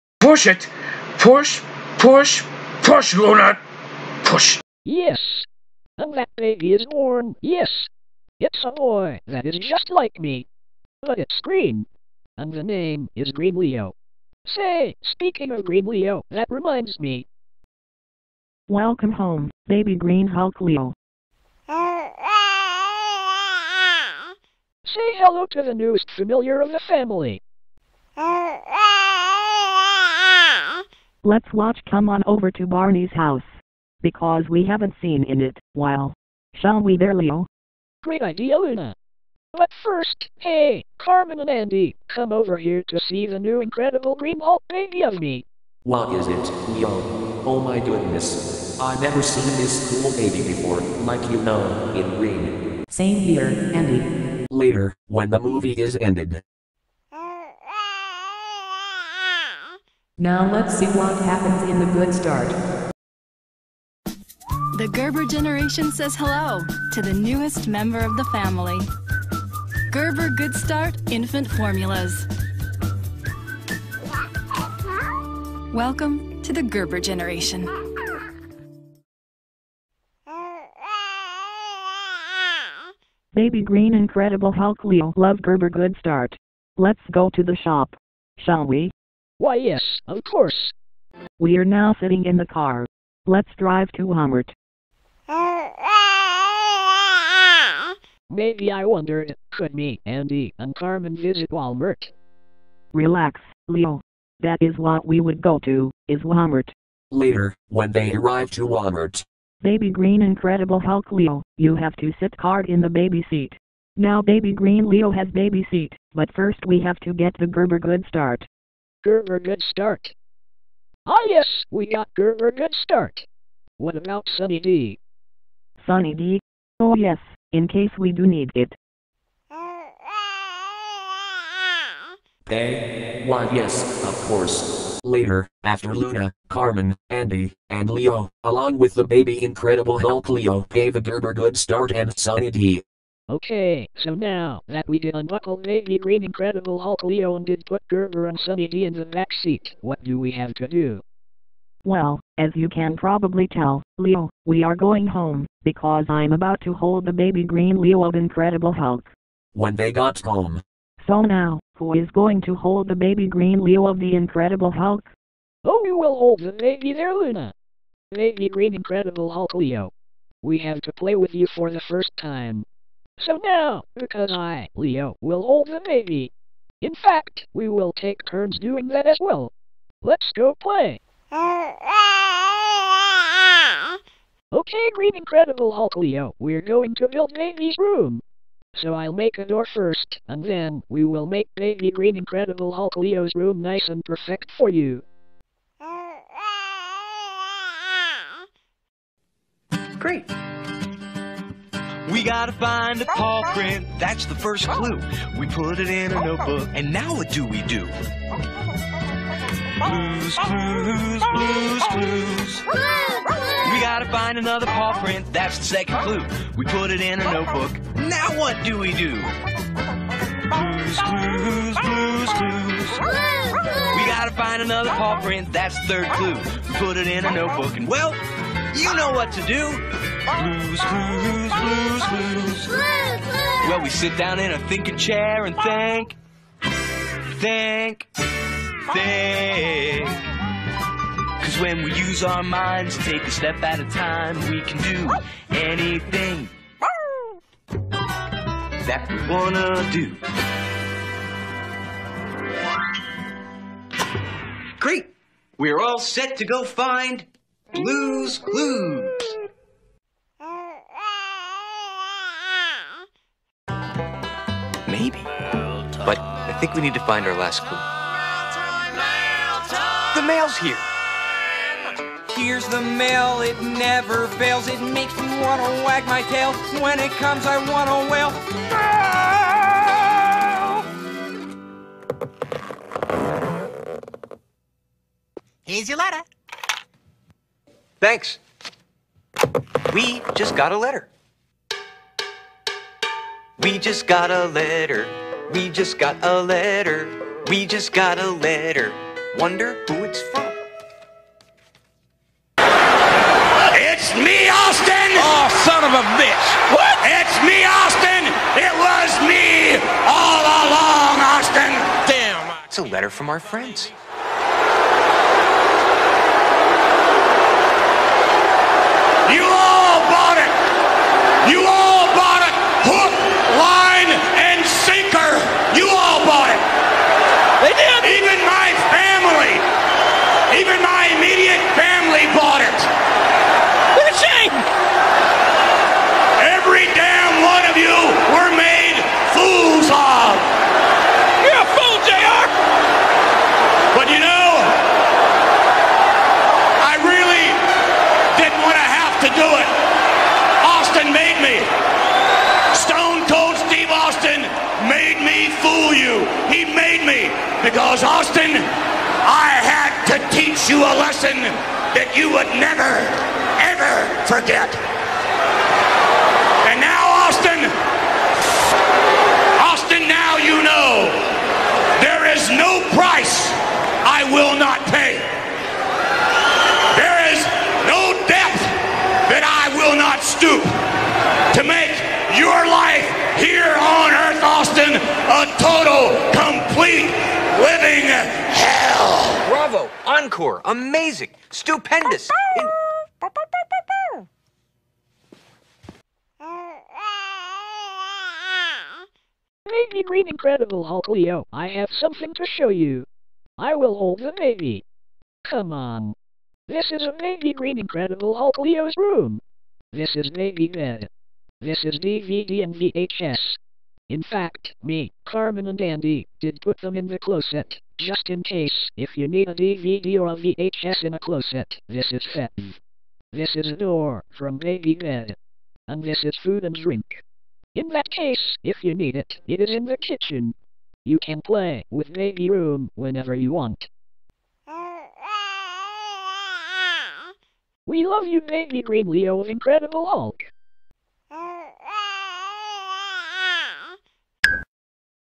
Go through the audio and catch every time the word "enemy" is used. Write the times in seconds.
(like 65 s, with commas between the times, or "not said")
not said.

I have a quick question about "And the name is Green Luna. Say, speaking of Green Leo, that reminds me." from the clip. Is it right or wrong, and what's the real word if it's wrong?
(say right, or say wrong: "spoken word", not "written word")
wrong: "Leo", not "Luna".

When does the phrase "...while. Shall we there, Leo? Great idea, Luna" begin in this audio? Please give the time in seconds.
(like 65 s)
35 s.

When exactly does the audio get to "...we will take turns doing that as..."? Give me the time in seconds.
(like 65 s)
177 s.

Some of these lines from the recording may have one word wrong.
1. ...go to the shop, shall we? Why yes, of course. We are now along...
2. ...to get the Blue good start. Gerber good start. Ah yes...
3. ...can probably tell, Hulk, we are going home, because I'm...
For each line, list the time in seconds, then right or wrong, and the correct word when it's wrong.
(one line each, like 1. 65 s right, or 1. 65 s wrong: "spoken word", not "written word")
1. 87 s wrong: "sitting", not "along"
2. 116 s wrong: "Gerber", not "Blue"
3. 152 s wrong: "Leo", not "Hulk".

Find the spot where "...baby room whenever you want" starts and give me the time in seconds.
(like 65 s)
432 s.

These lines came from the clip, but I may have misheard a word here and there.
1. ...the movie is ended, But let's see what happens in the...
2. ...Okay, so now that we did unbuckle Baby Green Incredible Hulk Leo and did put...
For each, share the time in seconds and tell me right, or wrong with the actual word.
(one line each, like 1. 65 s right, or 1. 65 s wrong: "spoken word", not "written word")
1. 55 s wrong: "Now", not "But"
2. 143 s right.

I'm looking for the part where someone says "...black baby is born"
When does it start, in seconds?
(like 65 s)
6 s.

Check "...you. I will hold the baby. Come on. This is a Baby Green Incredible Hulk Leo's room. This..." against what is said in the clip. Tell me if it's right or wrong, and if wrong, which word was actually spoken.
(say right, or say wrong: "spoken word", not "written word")
right.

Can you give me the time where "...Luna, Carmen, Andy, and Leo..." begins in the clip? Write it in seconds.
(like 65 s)
135 s.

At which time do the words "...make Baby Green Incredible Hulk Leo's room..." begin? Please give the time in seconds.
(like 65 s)
191 s.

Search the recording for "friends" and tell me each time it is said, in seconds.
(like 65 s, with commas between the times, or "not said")
313 s.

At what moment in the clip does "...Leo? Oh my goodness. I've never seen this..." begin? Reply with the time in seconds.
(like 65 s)
46 s.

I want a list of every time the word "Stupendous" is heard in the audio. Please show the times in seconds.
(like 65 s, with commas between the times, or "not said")
391 s.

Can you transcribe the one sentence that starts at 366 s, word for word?
And now, Austin, Austin, now you know there is no price I will not pay.